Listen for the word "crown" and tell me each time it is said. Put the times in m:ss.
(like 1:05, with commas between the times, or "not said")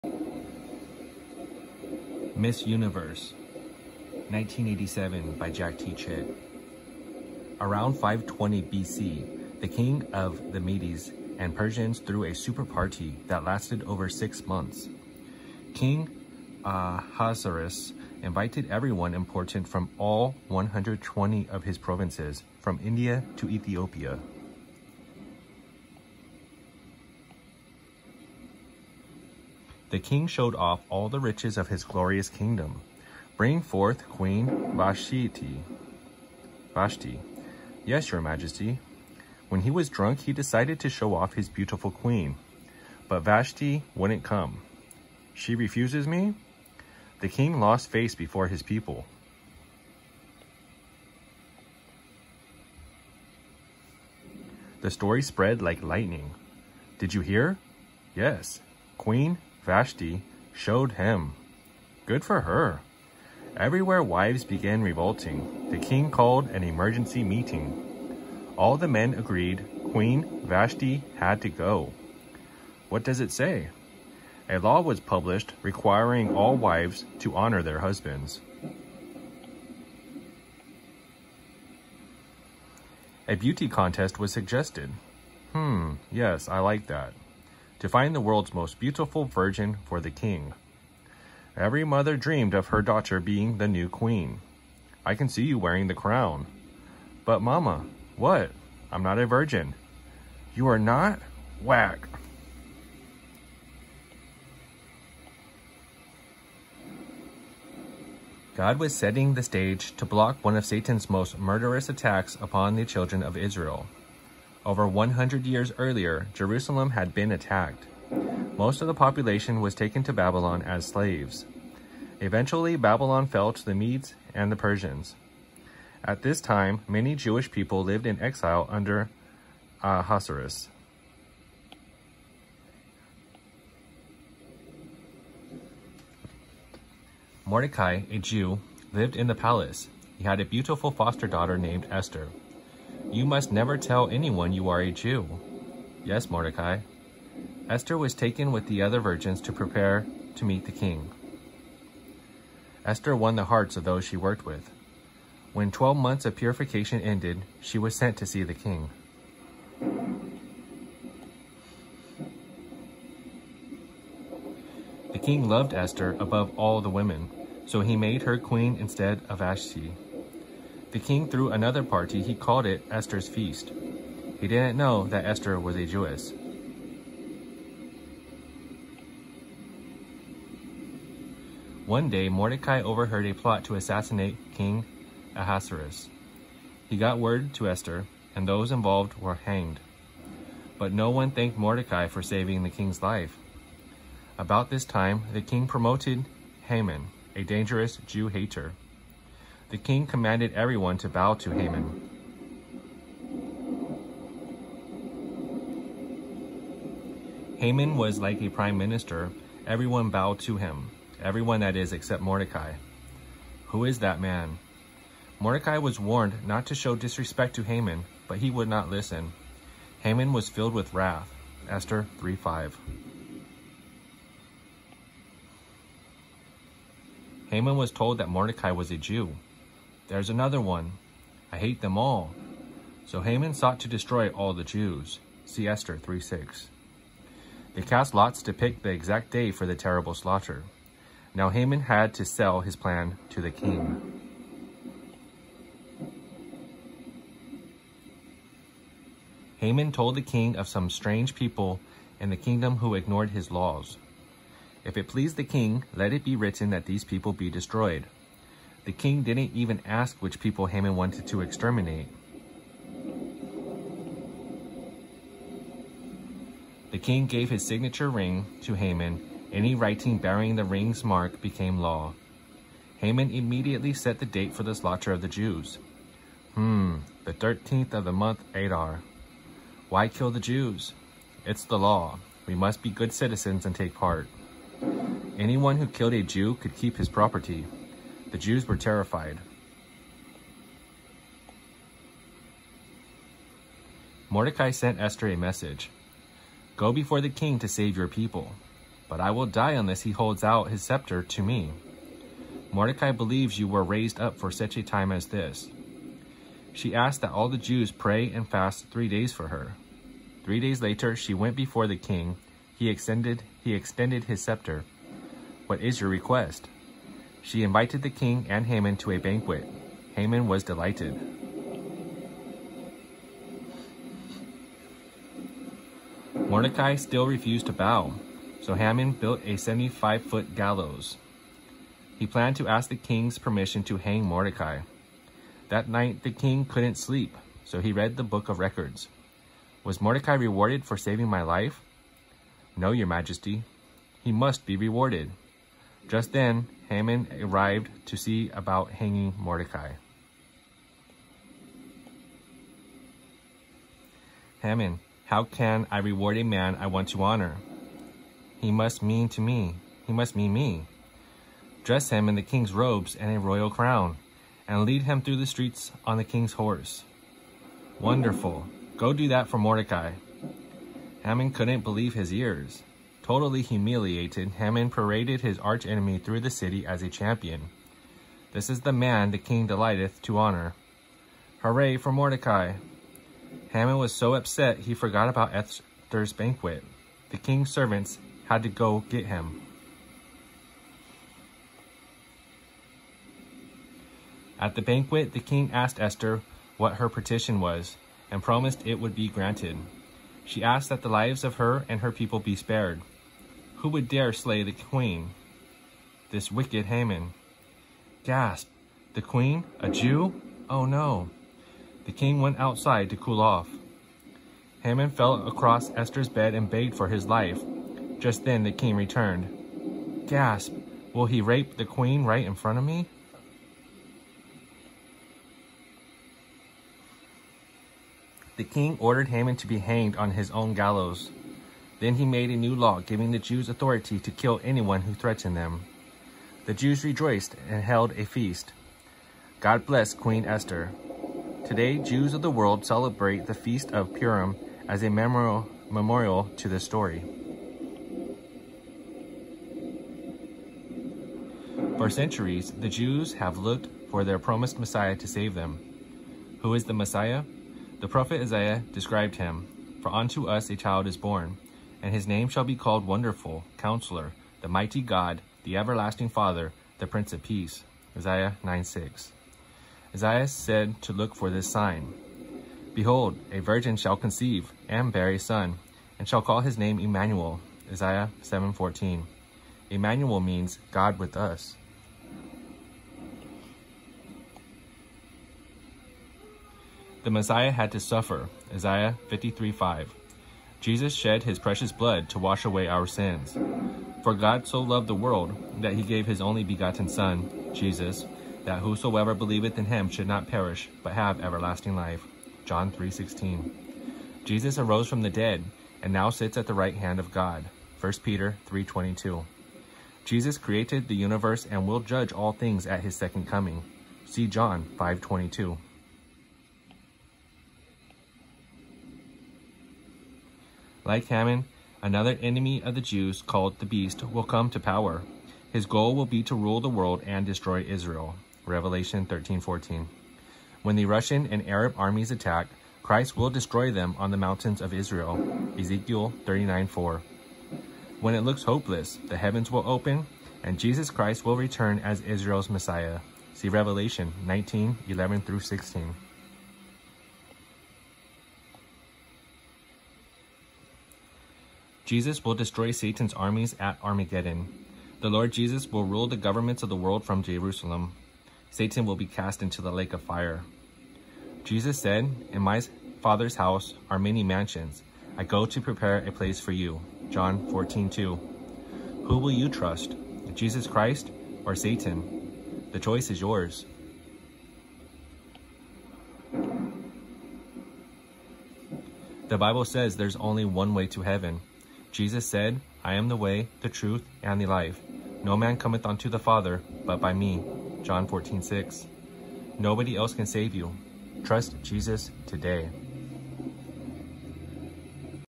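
1:35, 6:03.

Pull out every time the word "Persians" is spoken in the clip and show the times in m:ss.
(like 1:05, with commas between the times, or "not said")
0:11, 2:04.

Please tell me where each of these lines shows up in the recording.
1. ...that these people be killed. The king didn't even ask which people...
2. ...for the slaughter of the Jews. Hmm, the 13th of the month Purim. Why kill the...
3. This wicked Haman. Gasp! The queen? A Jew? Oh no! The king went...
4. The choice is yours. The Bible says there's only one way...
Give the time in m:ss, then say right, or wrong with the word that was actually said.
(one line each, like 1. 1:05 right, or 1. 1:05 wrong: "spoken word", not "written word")
1. 4:16 wrong: "destroyed", not "killed"
2. 4:34 wrong: "Adar", not "Purim"
3. 6:46 right
4. 9:32 right.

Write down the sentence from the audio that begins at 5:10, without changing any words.
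Three days later, she went before the king.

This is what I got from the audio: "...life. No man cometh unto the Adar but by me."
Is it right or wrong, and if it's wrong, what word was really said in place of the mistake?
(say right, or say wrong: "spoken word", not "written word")
wrong: "Father", not "Adar".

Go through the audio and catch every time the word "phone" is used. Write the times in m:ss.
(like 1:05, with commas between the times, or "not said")
not said.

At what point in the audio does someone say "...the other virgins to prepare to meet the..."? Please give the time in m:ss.
2:28.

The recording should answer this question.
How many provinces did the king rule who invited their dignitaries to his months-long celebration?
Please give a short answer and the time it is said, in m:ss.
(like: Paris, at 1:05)
120, at 0:20.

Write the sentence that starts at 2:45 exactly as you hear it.
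The king loved Esther above all the women, so he made her queen instead of Vashti.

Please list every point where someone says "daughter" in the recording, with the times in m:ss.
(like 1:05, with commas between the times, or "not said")
1:32, 2:21.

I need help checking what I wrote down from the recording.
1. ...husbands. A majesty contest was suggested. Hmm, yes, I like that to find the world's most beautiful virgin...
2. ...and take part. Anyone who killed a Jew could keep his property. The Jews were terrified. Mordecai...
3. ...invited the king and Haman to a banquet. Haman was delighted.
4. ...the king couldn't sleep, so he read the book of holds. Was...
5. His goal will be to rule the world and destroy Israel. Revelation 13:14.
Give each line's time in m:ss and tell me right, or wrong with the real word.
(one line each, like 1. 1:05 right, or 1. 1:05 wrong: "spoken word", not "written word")
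1. 1:17 wrong: "beauty", not "majesty"
2. 4:43 right
3. 5:17 right
4. 5:36 wrong: "records", not "holds"
5. 8:45 right.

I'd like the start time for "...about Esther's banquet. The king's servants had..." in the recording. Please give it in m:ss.
6:25.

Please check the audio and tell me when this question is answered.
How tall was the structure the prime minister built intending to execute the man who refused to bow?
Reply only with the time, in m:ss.
5:29.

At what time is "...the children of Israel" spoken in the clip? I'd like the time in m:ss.
1:52.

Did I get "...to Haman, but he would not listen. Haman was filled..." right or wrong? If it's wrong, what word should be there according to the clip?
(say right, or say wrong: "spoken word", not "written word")
right.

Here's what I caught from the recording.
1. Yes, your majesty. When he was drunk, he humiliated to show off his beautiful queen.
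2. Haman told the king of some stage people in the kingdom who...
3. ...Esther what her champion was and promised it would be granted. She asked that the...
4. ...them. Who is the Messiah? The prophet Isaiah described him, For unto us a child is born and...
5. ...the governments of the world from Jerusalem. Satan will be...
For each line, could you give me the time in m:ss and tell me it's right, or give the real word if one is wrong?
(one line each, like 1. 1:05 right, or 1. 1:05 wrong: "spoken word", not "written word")
1. 0:37 wrong: "decided", not "humiliated"
2. 4:09 wrong: "strange", not "stage"
3. 6:35 wrong: "petition", not "champion"
4. 7:35 right
5. 9:16 right.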